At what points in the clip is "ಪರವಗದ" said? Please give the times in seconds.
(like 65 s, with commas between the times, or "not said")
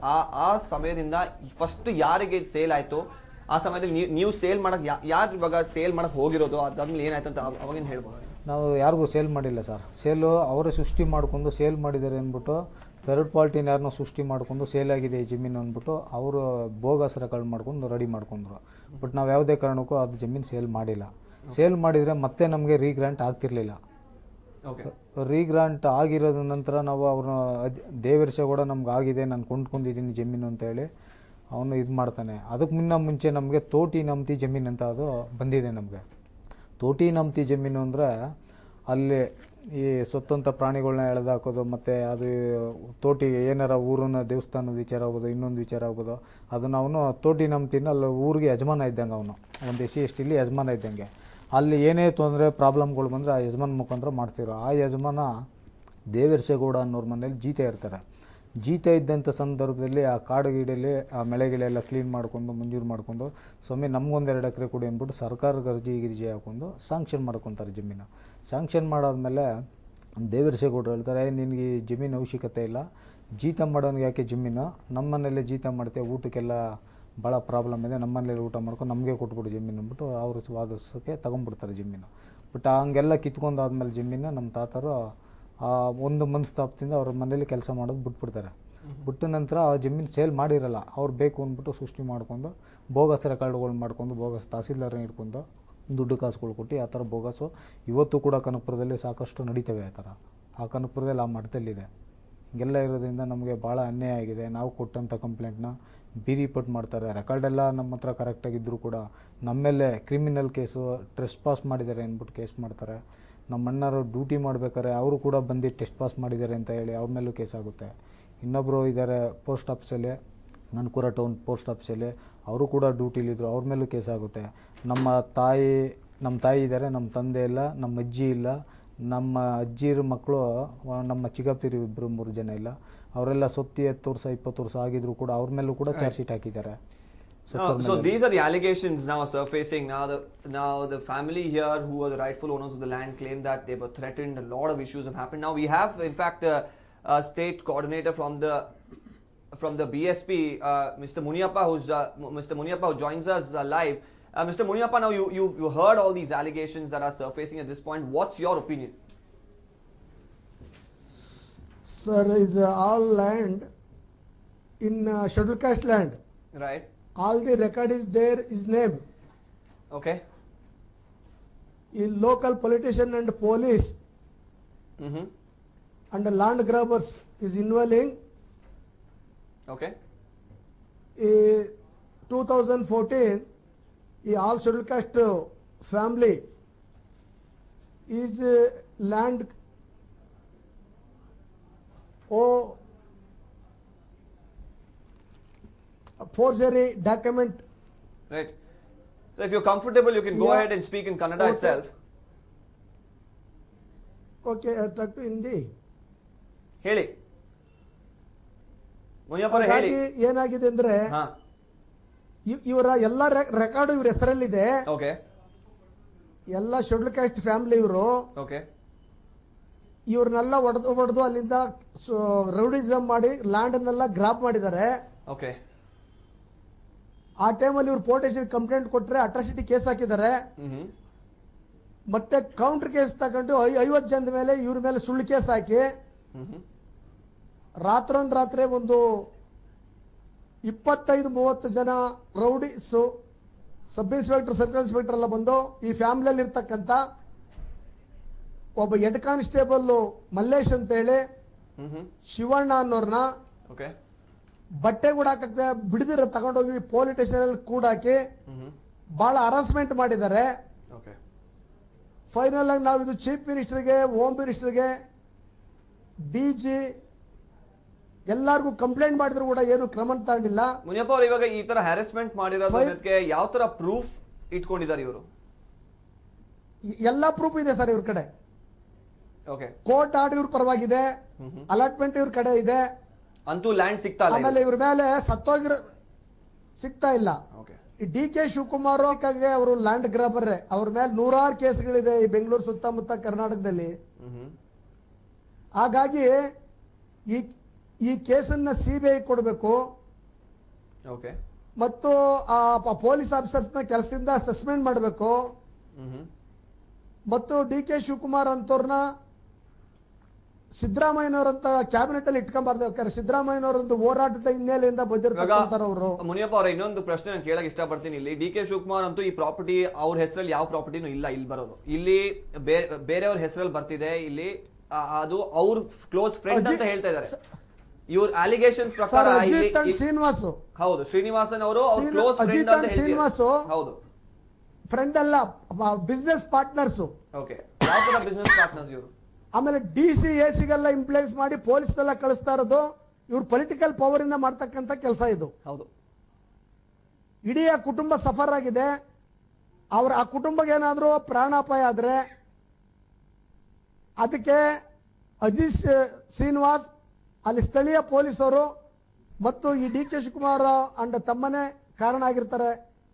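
280 s.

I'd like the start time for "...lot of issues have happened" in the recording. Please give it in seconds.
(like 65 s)
144 s.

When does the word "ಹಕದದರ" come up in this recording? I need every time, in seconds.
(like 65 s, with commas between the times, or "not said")
136 s, 229 s.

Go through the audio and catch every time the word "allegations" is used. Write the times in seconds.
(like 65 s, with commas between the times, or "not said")
138 s, 156 s.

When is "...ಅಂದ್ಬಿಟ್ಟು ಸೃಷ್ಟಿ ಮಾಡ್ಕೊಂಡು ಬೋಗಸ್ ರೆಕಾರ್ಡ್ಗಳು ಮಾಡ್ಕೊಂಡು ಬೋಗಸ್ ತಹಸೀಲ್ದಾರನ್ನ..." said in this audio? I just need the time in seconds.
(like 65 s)
91 s.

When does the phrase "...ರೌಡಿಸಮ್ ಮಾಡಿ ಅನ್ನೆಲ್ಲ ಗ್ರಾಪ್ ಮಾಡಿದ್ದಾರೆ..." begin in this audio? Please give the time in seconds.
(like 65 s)
222 s.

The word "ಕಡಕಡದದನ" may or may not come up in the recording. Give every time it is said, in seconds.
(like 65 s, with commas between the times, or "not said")
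29 s.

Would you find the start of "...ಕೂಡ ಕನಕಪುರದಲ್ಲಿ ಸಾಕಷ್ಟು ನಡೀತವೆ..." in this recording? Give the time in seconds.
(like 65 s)
98 s.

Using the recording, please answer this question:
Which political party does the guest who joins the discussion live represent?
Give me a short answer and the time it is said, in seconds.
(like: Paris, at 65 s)
BSP, at 149 s.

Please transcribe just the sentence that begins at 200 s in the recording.
ahead and speak in Kannada okay.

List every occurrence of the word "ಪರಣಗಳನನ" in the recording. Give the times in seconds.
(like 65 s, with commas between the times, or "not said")
40 s.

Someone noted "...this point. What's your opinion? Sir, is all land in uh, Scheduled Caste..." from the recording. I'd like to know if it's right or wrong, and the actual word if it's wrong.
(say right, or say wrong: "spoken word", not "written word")
right.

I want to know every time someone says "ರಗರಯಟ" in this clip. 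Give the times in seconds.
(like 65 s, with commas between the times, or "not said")
22 s.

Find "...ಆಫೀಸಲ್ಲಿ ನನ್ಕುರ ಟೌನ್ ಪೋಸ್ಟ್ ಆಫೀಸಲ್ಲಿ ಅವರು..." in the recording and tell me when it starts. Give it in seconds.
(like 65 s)
119 s.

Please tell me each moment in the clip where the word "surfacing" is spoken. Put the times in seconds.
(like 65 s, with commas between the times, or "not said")
139 s, 157 s.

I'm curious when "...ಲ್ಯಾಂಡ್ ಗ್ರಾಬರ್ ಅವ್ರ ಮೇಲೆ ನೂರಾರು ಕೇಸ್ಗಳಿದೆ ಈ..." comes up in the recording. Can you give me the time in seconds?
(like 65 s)
289 s.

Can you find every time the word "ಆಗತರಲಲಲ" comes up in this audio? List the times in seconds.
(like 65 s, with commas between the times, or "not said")
23 s.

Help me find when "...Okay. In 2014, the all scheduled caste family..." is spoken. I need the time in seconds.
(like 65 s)
179 s.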